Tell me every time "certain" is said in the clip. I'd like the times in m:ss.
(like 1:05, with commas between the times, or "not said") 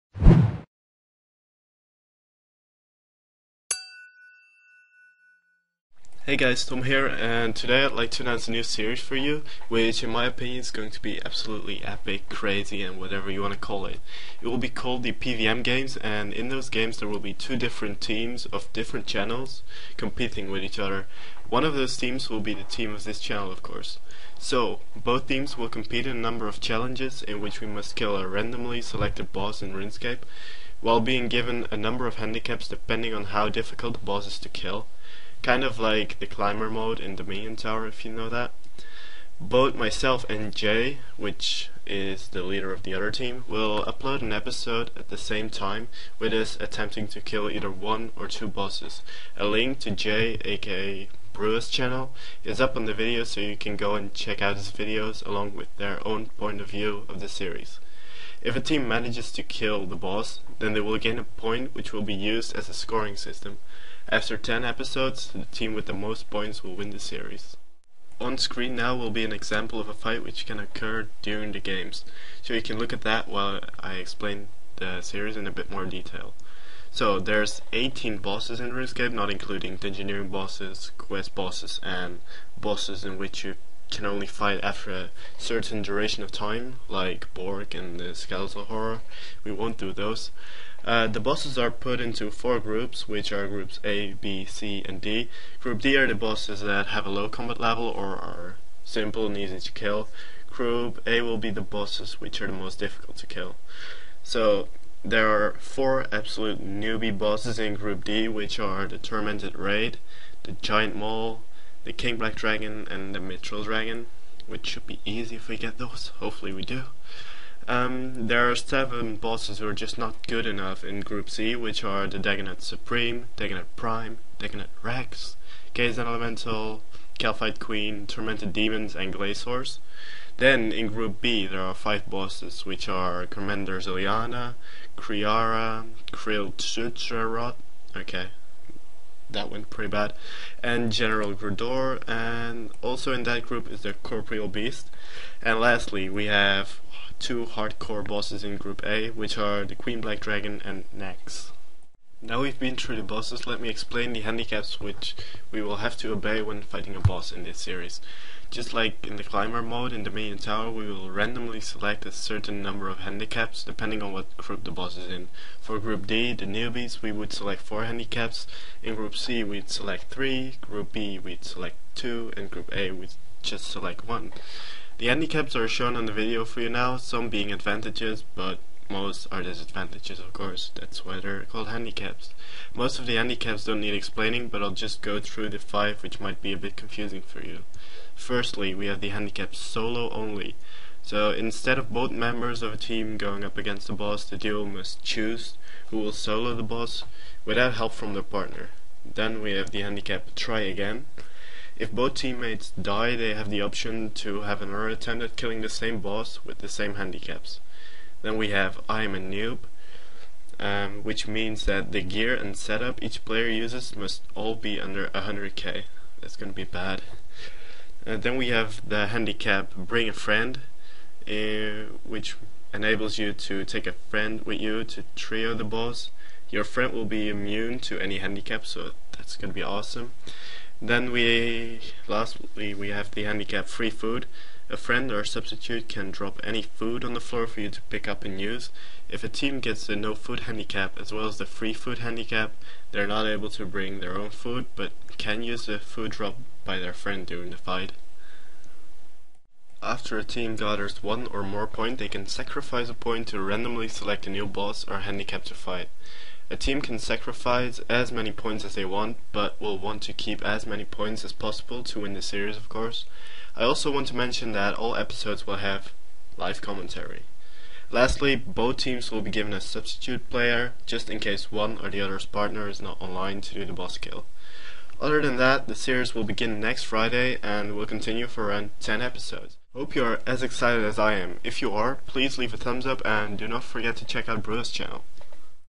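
1:25, 2:42.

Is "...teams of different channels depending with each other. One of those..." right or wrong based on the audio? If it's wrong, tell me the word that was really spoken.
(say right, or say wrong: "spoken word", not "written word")
wrong: "competing", not "depending".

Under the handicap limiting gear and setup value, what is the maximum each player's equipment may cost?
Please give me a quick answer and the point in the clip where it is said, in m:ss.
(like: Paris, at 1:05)
100k, at 3:35.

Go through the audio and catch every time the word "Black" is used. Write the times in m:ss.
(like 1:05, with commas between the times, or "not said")
1:52, 2:30.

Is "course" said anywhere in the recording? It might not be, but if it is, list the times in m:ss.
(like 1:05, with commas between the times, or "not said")
0:23, 3:00, 4:22.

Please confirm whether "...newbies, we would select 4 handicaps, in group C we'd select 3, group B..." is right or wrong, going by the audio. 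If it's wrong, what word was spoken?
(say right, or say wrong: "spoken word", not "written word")
right.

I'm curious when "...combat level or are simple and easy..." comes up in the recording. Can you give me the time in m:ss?
1:37.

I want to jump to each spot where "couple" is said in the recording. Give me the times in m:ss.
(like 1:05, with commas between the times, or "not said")
not said.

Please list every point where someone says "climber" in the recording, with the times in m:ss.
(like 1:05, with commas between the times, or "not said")
0:36, 2:39.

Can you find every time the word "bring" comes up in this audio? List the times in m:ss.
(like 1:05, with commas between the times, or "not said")
3:39, 4:03.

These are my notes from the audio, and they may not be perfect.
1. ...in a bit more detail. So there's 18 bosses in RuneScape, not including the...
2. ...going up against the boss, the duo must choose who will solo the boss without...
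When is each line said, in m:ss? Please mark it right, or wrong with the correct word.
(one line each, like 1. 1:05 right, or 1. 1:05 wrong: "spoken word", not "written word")
1. 1:15 right
2. 3:13 right.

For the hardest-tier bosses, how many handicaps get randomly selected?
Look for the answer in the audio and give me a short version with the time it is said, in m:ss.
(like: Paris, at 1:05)
1, at 2:54.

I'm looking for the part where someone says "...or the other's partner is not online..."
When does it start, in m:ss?
4:31.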